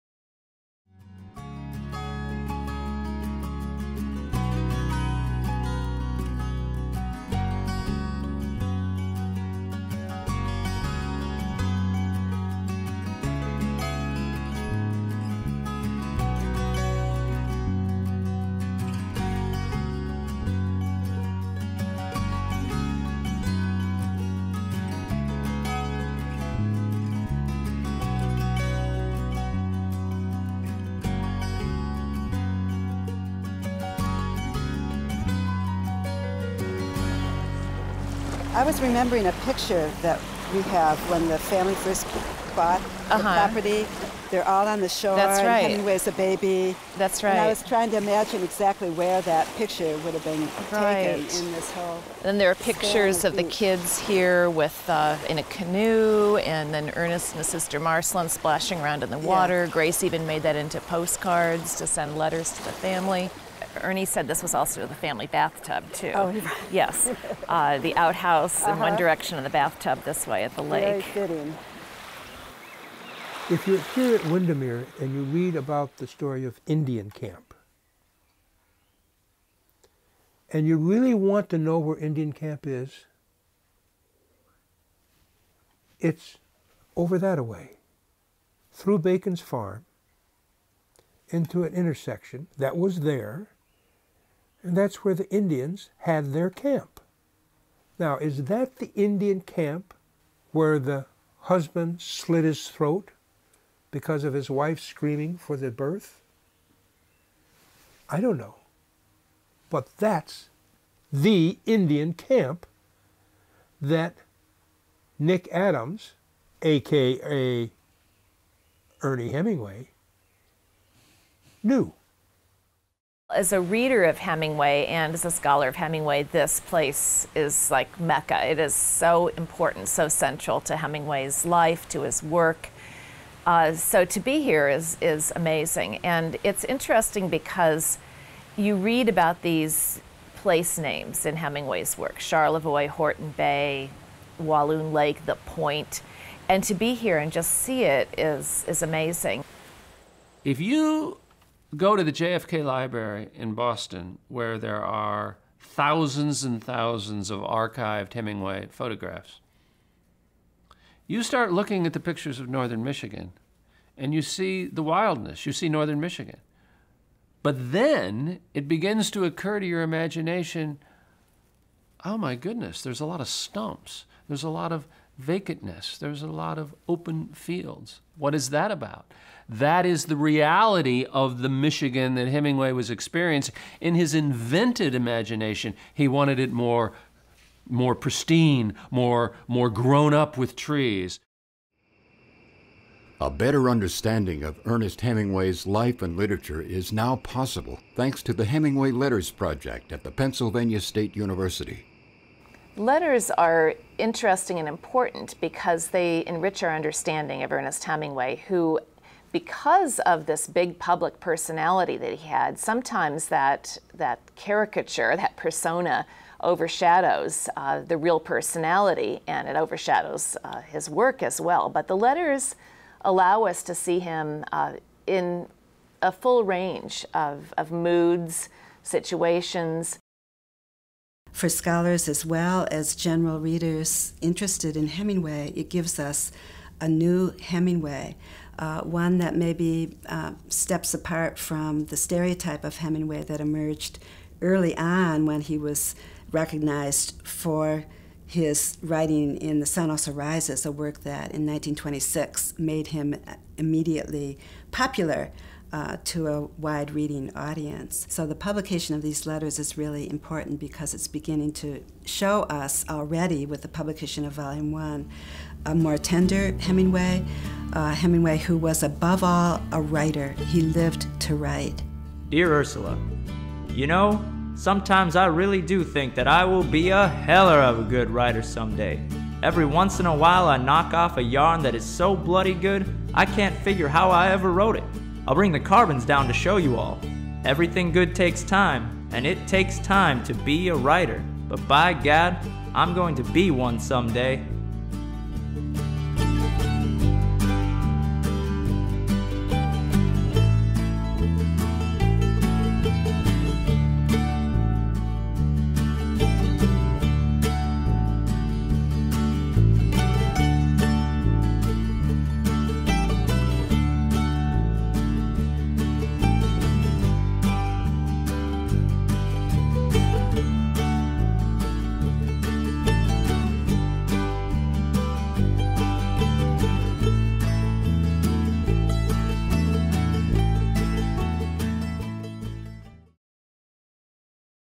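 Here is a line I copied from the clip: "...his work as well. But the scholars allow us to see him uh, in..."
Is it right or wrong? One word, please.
wrong.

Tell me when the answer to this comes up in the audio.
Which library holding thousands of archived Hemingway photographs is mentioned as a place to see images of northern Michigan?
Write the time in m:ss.
2:32.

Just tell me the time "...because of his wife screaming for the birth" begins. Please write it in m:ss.
1:43.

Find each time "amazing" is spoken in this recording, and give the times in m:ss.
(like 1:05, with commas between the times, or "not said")
2:15, 2:28.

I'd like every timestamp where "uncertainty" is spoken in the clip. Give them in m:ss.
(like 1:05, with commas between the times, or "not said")
not said.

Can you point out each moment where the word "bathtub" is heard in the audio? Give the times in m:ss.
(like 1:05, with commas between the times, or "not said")
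1:05, 1:09.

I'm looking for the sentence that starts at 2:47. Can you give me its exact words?
But then it begins to occur to your imagination oh my goodness, there's a lot of stumps, there's a lot of vacantness.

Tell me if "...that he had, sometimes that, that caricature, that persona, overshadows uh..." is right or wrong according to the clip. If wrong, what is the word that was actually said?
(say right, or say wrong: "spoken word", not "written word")
right.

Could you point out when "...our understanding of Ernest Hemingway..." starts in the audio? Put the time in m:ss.
3:26.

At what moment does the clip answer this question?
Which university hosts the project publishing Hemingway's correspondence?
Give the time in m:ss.
3:20.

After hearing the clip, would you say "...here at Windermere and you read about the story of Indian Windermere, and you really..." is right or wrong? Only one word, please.
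wrong.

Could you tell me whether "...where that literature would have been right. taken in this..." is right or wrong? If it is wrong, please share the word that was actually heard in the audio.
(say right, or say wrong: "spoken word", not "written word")
wrong: "picture", not "literature".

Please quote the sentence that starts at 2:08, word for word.
It is so important, so central to Hemingway's life, to his work.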